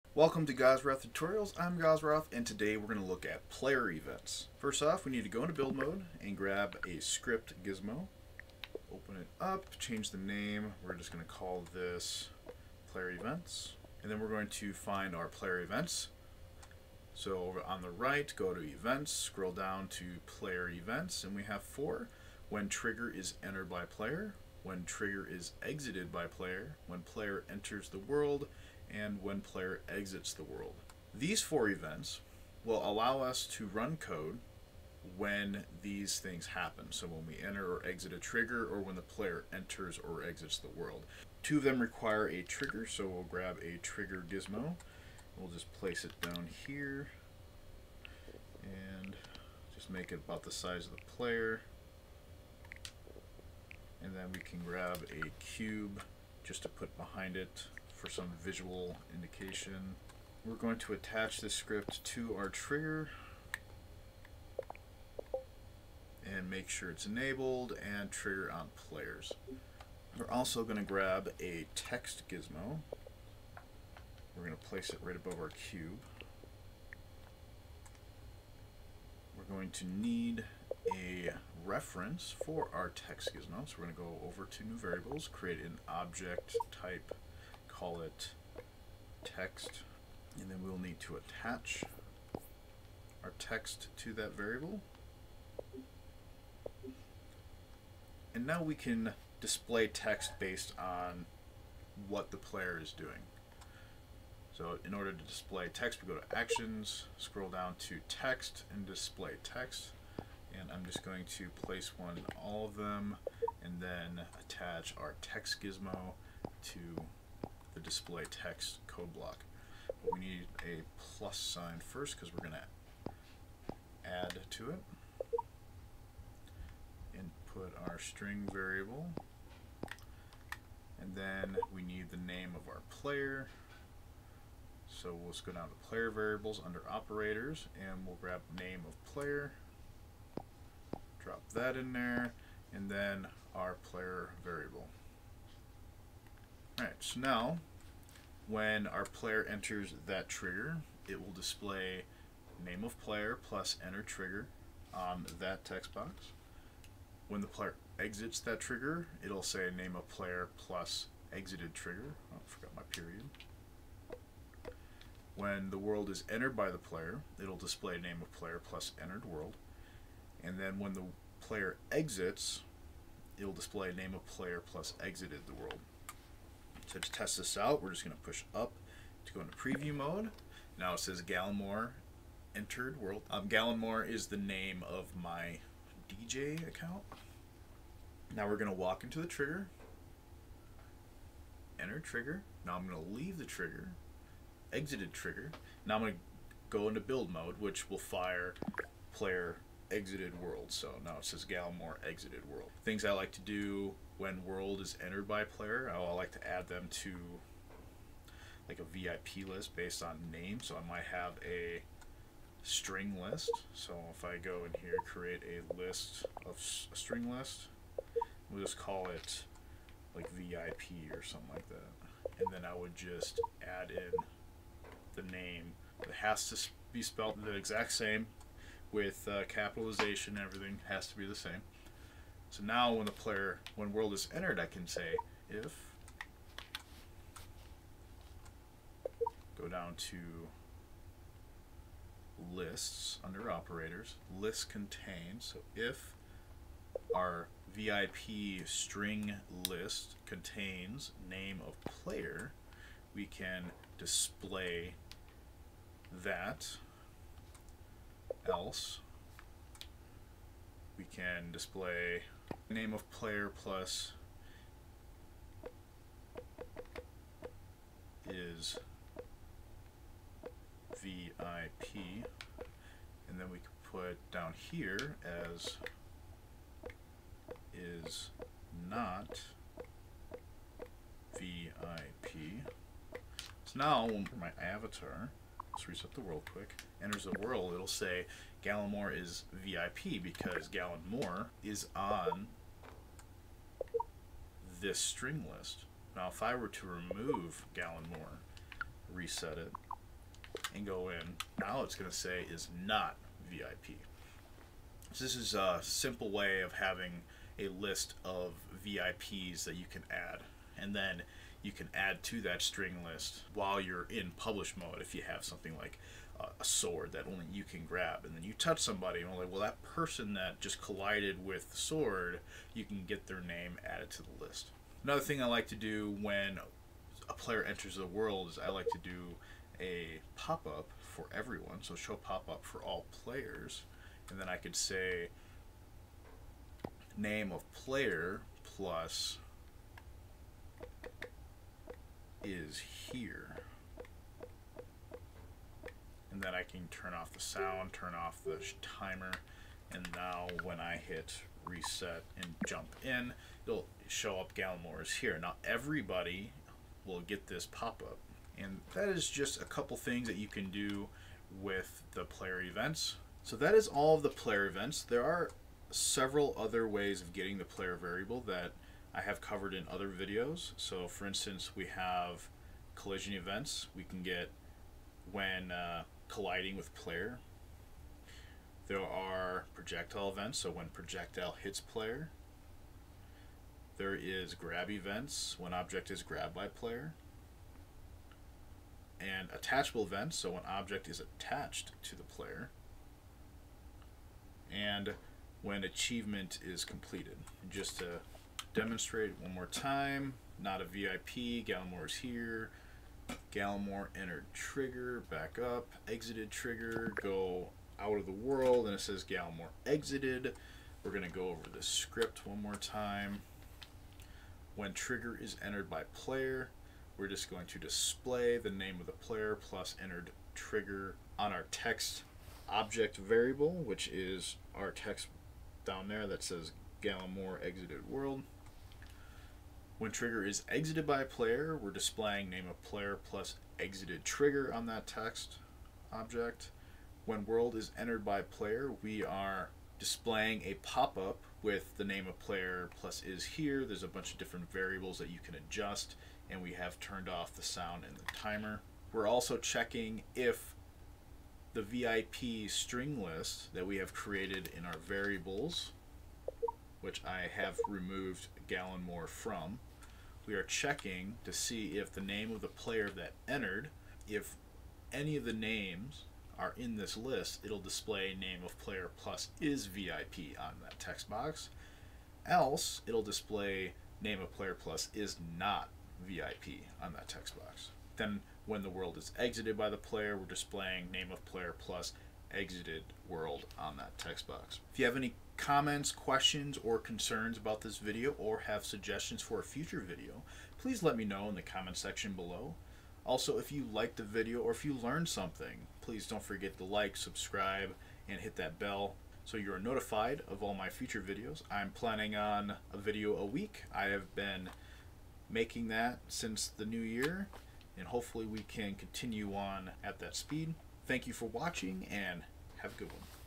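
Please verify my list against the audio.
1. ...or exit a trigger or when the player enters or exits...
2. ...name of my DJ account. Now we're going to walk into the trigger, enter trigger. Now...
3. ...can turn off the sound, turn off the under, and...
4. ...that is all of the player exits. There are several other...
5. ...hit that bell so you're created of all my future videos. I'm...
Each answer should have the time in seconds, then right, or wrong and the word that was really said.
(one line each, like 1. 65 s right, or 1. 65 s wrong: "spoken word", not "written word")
1. 37 s right
2. 184 s right
3. 346 s wrong: "timer", not "under"
4. 363 s wrong: "events", not "exits"
5. 498 s wrong: "notified", not "created".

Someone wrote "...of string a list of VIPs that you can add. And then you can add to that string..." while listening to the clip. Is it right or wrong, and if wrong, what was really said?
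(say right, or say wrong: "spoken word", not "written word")
wrong: "having", not "string".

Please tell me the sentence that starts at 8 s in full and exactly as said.
Open it up, change the name, we're just going to call this player events.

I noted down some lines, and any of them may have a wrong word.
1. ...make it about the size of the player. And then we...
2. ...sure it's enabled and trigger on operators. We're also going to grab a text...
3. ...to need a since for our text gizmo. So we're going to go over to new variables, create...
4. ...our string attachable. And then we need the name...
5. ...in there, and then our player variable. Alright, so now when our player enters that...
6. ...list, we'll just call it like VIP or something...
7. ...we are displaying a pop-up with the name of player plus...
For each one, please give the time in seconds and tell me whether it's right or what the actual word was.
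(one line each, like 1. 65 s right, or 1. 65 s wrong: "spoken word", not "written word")
1. 49 s right
2. 66 s wrong: "players", not "operators"
3. 79 s wrong: "reference", not "since"
4. 127 s wrong: "variable", not "attachable"
5. 141 s right
6. 217 s right
7. 439 s right.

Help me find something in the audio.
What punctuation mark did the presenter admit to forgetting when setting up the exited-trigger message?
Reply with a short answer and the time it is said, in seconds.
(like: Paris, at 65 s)
period, at 162 s.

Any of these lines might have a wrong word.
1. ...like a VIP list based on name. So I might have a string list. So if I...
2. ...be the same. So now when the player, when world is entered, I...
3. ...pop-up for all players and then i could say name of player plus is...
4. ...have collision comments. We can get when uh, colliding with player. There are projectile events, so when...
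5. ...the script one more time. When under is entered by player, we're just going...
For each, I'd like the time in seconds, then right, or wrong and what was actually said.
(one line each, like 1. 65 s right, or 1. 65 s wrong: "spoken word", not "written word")
1. 208 s right
2. 231 s right
3. 332 s right
4. 371 s wrong: "events", not "comments"
5. 411 s wrong: "trigger", not "under".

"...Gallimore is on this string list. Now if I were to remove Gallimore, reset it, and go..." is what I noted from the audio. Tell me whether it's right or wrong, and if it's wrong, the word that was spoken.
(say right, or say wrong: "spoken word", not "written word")
right.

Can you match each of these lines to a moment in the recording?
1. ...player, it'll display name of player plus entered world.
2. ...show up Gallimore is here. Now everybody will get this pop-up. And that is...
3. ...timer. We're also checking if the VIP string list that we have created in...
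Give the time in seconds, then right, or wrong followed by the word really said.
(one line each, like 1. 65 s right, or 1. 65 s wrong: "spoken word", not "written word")
1. 166 s right
2. 354 s right
3. 448 s right.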